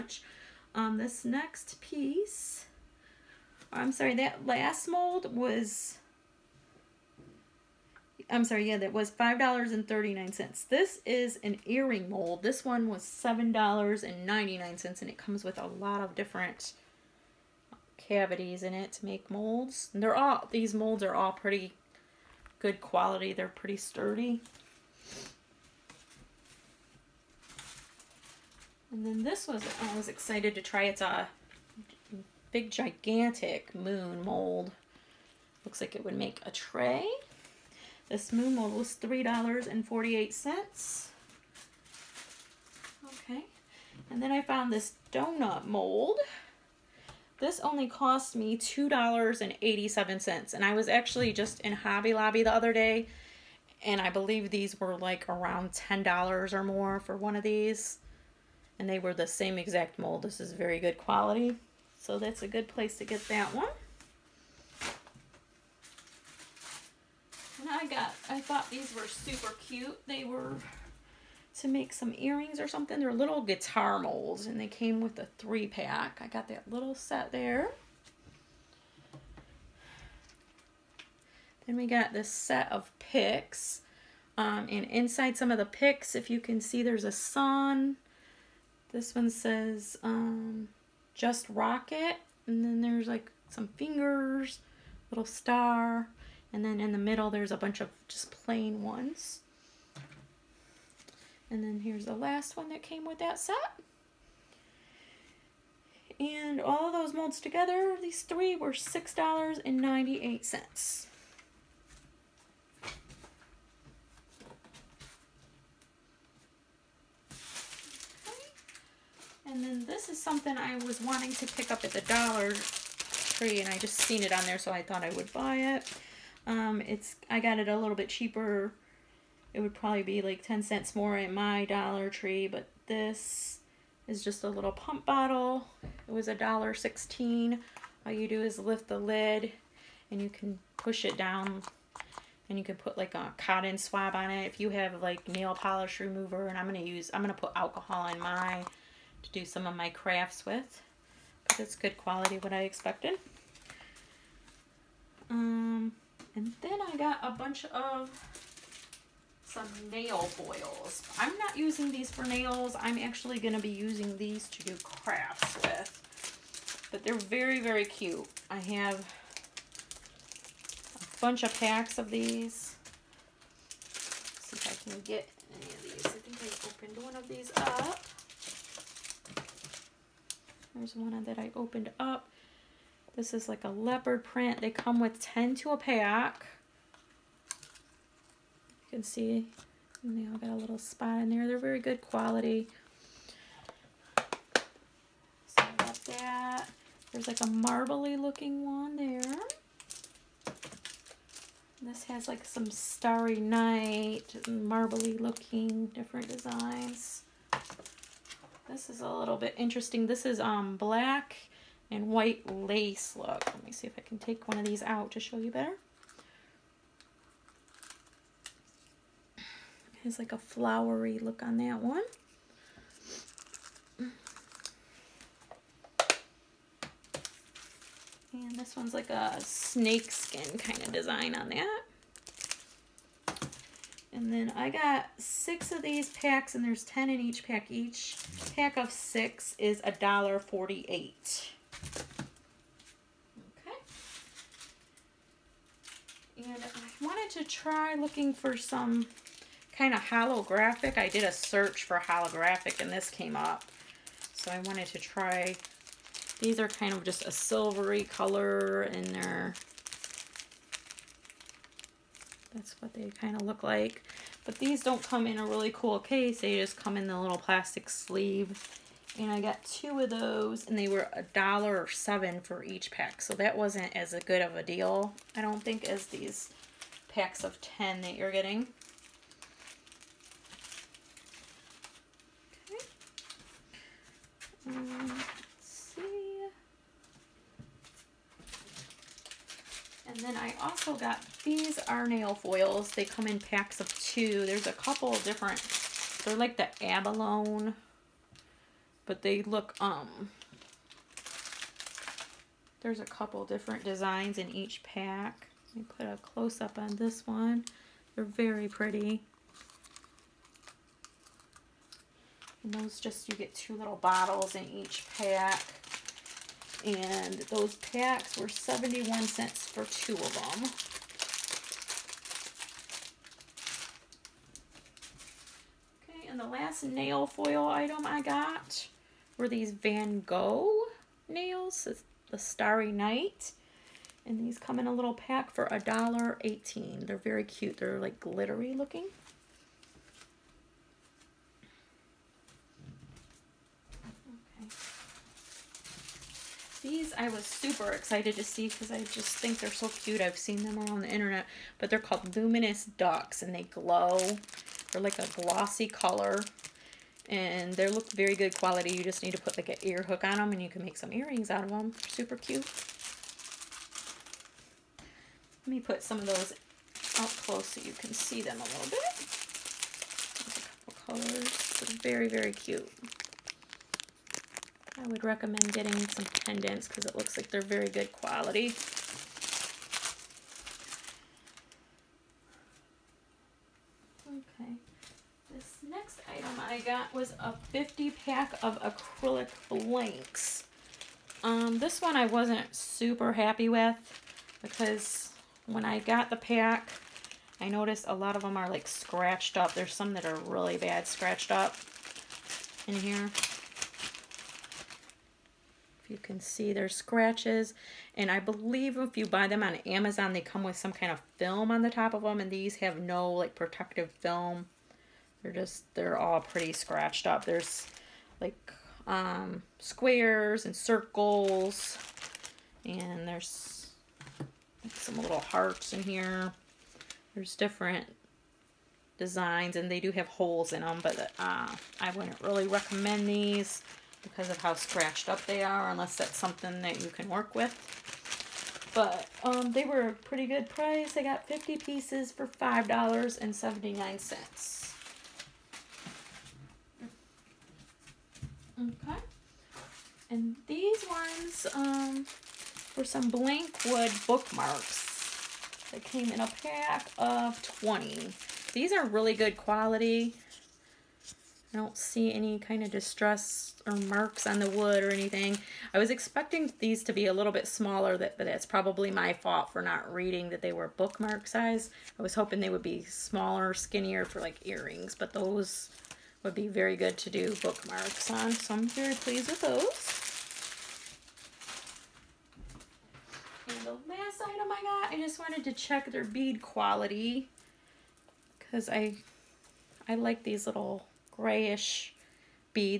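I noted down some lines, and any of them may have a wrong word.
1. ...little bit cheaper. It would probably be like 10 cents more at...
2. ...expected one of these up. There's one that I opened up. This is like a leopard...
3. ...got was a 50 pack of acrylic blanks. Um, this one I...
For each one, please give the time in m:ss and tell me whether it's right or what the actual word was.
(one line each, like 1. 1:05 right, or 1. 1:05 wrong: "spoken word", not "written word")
1. 2:07 right
2. 2:57 wrong: "opened", not "expected"
3. 6:26 right.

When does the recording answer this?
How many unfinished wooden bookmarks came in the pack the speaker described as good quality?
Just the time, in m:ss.
7:37.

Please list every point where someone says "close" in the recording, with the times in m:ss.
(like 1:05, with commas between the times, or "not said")
5:06, 6:07.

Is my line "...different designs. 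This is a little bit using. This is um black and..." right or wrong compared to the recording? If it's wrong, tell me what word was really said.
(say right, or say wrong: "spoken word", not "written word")
wrong: "interesting", not "using".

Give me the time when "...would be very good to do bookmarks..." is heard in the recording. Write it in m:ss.
7:56.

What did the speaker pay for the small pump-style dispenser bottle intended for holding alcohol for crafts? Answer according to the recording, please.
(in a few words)
$1.16.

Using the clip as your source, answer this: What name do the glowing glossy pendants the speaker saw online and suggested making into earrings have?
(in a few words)
Luminous Ducks.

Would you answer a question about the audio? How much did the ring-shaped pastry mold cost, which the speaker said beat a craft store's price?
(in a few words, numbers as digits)
$2.87.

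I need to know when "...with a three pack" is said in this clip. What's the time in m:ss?
1:15.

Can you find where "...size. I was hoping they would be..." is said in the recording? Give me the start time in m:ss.
7:51.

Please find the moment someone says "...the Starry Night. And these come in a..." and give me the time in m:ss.
5:32.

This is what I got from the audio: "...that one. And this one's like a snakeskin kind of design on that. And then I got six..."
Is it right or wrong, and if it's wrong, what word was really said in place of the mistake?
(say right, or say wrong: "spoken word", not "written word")
right.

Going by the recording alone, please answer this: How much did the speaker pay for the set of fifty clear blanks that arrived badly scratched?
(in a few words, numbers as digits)
$5.79.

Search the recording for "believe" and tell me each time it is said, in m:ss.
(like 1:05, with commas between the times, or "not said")
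0:54, 6:48.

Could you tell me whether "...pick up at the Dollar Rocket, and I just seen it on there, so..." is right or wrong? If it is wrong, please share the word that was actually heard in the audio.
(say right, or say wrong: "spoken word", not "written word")
wrong: "Tree", not "Rocket".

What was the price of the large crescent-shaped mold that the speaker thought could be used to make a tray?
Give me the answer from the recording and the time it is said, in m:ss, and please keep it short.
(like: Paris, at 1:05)
$3.48, at 0:38.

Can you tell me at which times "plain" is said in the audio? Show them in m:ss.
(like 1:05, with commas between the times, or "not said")
1:38.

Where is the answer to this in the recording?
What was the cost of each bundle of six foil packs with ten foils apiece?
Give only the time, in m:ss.
3:59.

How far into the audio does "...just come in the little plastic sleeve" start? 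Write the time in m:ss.
4:26.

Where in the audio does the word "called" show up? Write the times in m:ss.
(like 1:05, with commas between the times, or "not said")
5:51.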